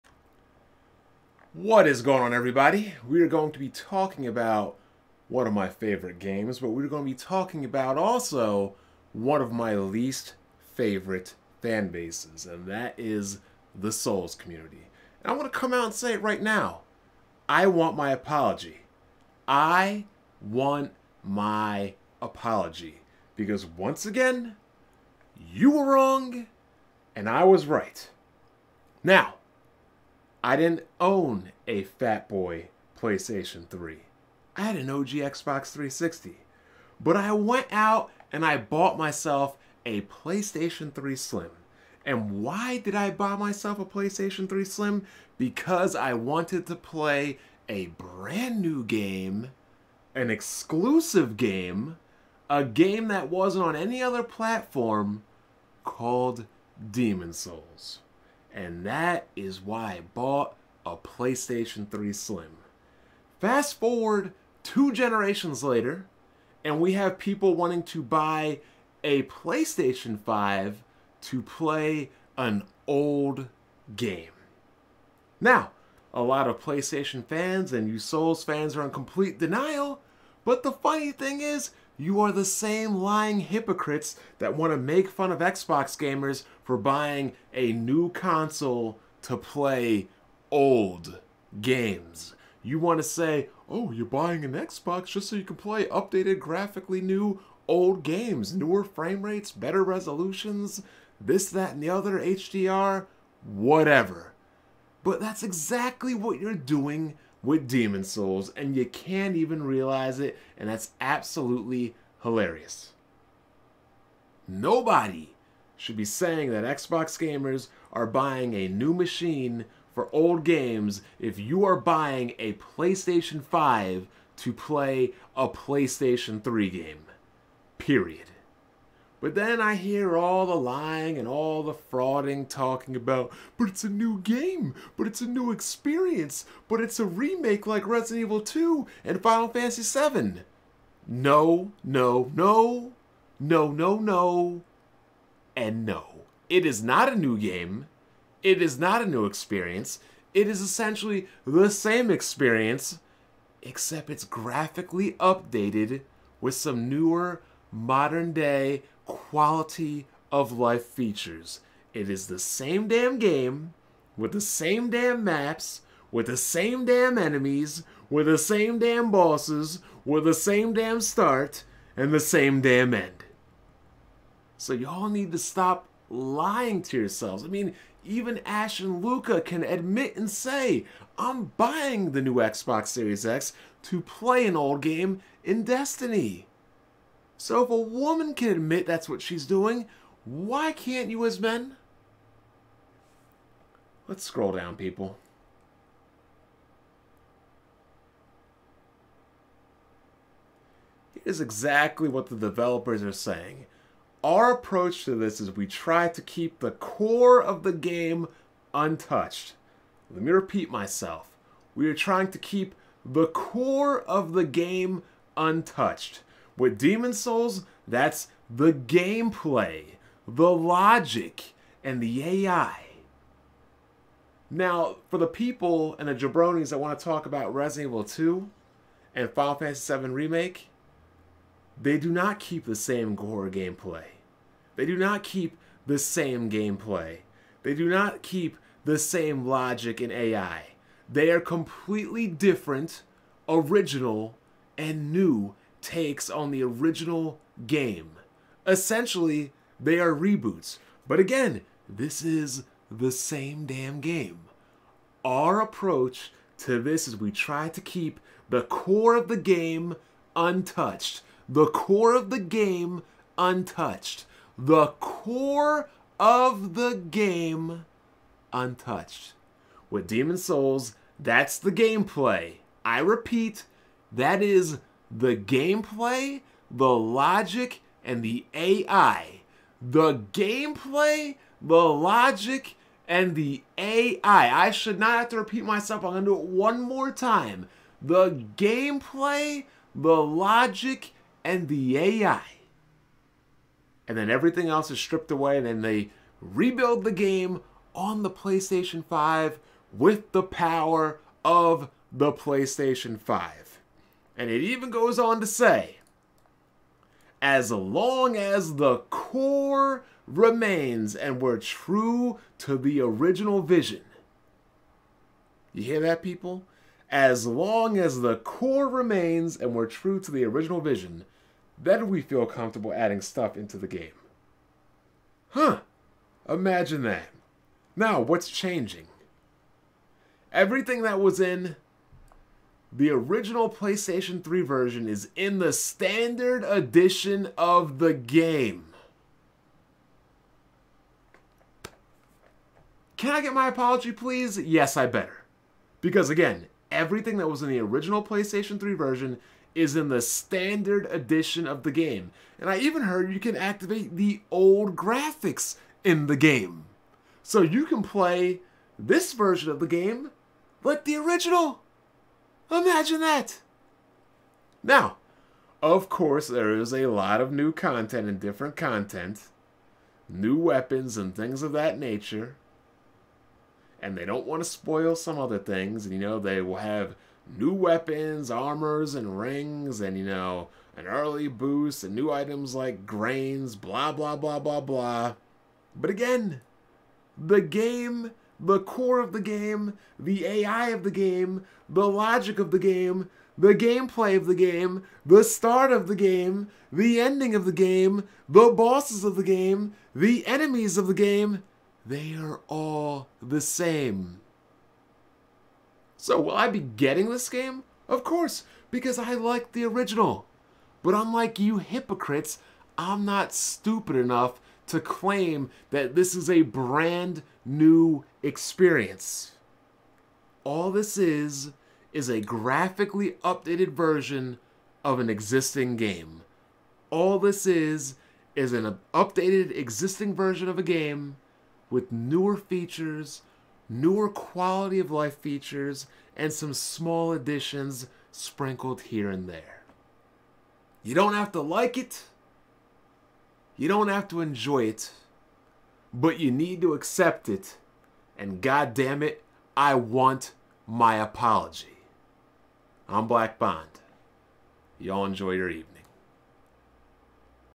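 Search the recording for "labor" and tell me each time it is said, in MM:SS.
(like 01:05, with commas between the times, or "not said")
not said.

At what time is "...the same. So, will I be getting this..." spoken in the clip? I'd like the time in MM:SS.
06:43.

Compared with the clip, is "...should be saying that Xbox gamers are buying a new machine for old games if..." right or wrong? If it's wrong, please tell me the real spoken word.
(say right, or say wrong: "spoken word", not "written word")
right.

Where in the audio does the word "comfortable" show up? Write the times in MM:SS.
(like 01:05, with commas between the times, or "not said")
05:22.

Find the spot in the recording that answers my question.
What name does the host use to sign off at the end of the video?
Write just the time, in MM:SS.
07:33.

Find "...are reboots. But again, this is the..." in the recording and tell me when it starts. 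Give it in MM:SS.
04:09.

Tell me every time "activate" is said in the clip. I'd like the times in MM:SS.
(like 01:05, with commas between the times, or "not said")
05:53.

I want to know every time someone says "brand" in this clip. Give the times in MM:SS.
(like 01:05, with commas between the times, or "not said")
00:47, 06:56.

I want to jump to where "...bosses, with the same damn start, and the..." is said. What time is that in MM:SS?
02:49.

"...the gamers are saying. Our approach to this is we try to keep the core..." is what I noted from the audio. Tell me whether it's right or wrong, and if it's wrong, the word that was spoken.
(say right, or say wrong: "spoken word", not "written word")
wrong: "developers", not "gamers".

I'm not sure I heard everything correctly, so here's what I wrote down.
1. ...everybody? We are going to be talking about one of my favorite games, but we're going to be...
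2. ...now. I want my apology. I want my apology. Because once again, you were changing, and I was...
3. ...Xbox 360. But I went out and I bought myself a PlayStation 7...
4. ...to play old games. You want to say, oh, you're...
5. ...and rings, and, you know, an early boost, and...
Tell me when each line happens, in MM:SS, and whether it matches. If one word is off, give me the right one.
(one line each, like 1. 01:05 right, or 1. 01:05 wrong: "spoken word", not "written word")
1. 00:02 right
2. 00:16 wrong: "wrong", not "changing"
3. 00:35 wrong: "3", not "7"
4. 01:29 right
5. 06:19 right.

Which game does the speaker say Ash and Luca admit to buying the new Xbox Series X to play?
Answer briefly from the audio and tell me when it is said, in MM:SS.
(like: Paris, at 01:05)
Destiny, at 03:05.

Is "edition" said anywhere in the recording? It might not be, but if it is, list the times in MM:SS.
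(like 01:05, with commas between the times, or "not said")
05:36, 05:51.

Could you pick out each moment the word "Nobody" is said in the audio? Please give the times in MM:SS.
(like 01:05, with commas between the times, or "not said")
01:54.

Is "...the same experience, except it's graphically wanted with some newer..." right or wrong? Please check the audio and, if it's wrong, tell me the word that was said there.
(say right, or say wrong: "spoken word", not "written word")
wrong: "updated", not "wanted".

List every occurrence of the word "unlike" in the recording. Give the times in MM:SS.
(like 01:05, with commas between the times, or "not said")
06:51.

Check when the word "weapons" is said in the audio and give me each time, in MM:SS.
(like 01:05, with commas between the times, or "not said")
06:10, 06:17.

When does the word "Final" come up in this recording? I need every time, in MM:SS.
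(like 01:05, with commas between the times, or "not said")
02:19, 03:49.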